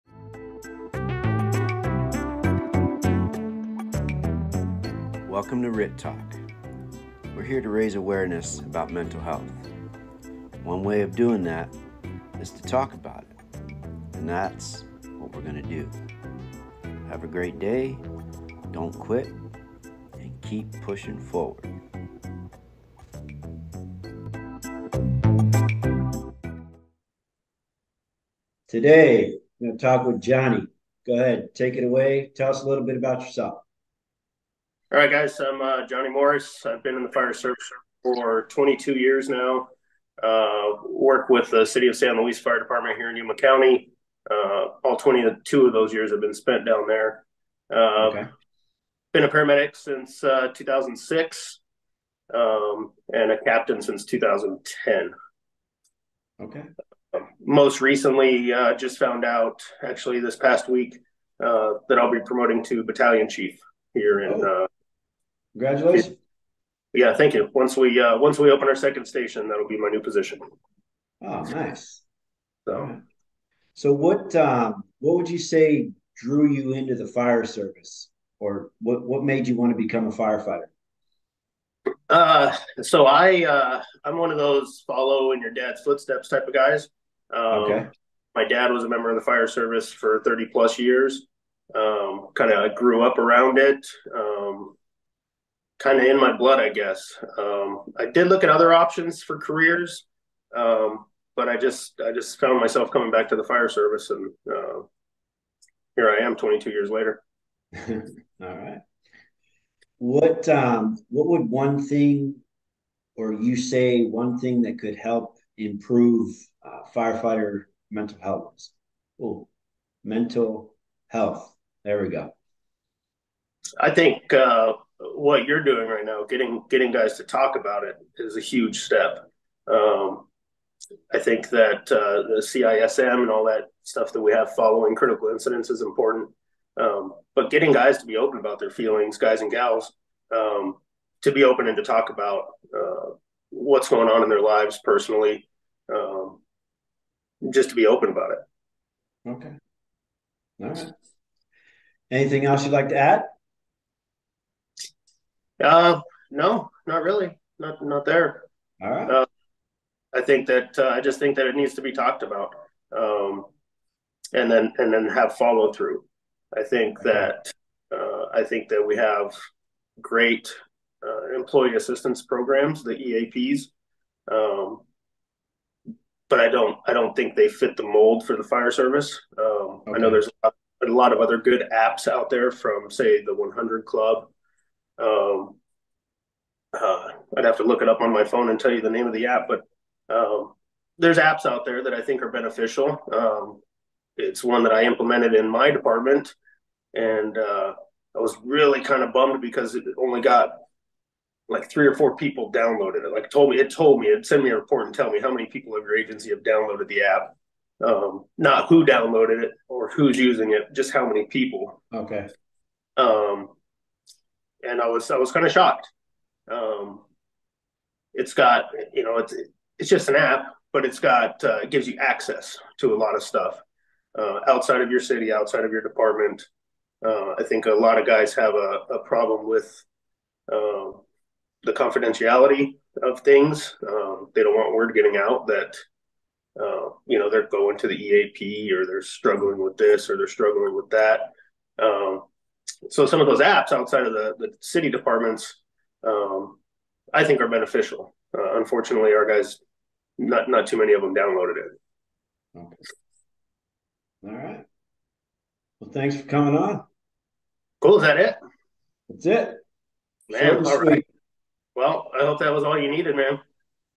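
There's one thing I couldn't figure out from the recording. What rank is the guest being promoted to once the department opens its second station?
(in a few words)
Battalion chief.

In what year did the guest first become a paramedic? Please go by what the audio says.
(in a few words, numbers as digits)
2006.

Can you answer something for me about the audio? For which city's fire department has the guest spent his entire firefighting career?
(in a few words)
San Luis.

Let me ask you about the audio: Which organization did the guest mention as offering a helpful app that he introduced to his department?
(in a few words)
The 100 Club.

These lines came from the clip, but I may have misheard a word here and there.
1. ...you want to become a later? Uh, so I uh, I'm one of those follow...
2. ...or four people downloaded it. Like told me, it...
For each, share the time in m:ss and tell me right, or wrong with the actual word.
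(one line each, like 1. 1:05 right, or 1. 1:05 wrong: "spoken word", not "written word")
1. 1:19 wrong: "firefighter", not "later"
2. 3:21 right.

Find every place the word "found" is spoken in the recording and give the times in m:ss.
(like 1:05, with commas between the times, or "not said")
0:58, 1:42.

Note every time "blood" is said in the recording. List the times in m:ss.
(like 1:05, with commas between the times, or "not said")
1:36.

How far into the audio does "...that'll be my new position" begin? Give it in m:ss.
1:09.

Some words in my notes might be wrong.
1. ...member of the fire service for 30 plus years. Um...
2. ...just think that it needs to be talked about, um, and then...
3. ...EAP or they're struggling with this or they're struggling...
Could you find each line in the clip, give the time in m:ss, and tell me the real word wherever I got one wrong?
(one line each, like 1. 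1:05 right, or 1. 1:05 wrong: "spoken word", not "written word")
1. 1:28 right
2. 2:41 right
3. 3:57 right.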